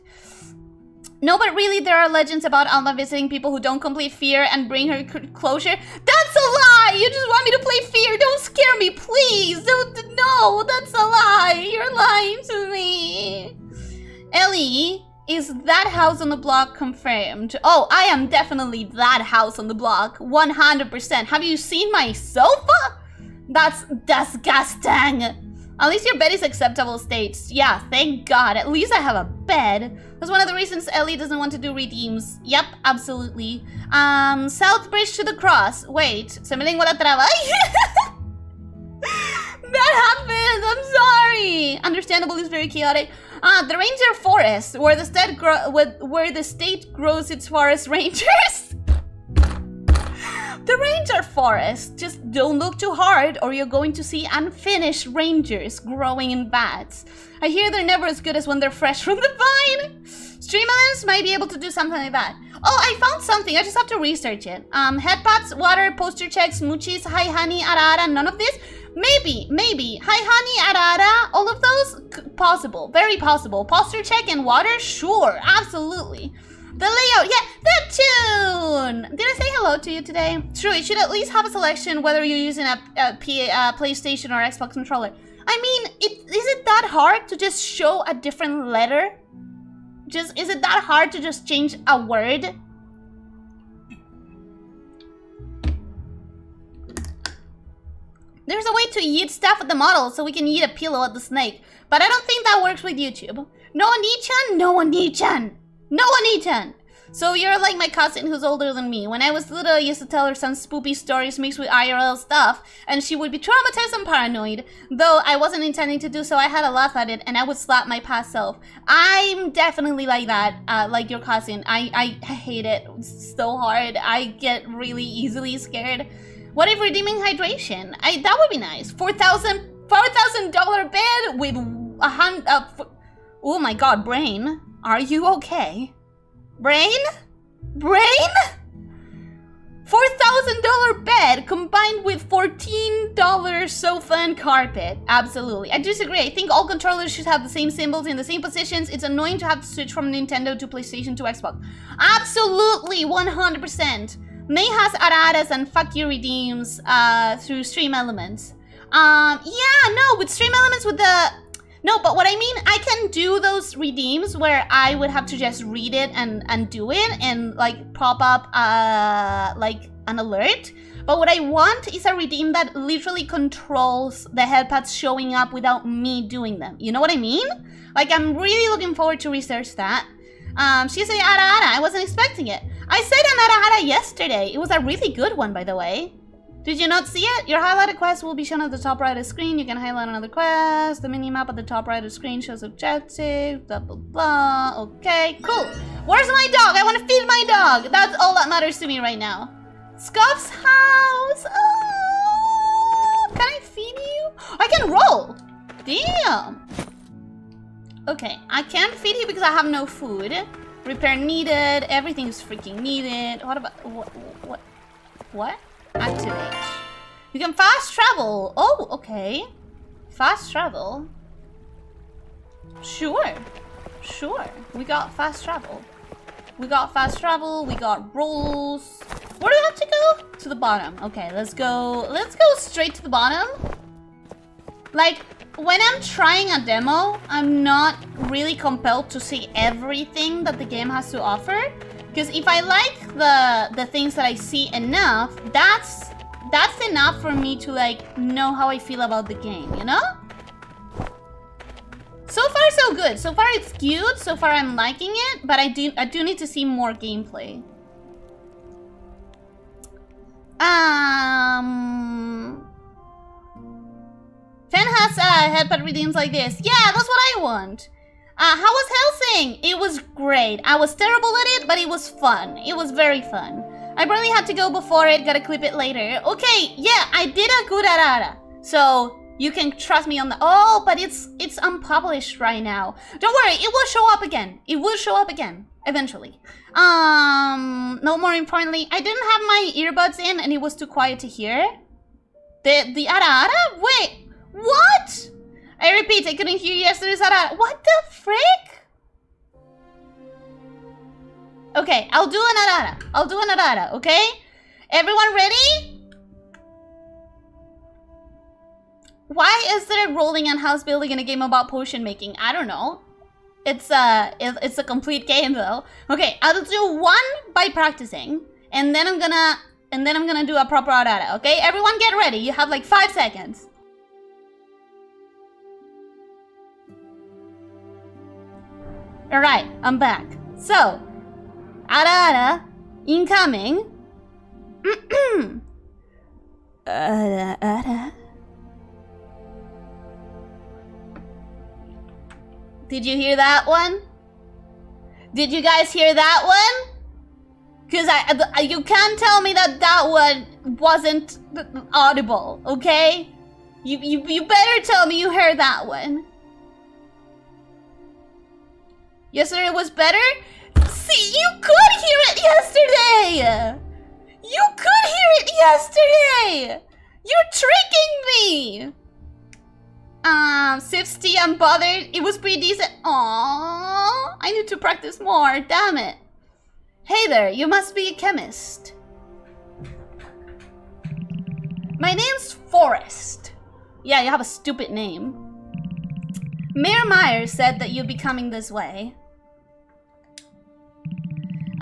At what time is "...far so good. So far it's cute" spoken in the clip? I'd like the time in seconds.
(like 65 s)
252 s.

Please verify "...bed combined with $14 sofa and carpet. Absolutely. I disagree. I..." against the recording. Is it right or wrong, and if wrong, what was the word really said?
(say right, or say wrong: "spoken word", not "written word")
right.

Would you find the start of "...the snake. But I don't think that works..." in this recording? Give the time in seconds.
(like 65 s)
101 s.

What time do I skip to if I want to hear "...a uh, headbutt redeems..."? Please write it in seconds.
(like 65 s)
265 s.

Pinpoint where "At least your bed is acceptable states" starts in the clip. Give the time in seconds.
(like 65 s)
25 s.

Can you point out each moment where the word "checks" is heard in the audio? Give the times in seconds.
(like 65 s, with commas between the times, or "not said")
66 s, 74 s.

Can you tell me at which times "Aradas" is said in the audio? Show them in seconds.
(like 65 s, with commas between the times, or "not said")
154 s.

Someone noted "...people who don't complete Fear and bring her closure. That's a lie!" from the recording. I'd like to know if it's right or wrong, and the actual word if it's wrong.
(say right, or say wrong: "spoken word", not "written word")
right.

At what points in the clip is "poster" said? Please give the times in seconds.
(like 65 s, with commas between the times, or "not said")
65 s, 73 s.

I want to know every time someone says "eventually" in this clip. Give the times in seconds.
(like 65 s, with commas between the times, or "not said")
285 s.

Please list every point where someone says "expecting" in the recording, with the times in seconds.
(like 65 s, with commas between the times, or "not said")
182 s.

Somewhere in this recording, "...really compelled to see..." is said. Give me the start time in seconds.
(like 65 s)
238 s.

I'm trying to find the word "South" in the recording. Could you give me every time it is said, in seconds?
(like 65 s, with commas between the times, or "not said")
34 s.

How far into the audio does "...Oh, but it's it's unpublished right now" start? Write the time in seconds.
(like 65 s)
280 s.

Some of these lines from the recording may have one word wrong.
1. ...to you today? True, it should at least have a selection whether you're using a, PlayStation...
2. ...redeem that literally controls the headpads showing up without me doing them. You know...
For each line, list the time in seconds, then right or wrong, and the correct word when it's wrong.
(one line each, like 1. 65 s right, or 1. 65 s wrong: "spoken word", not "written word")
1. 79 s right
2. 172 s right.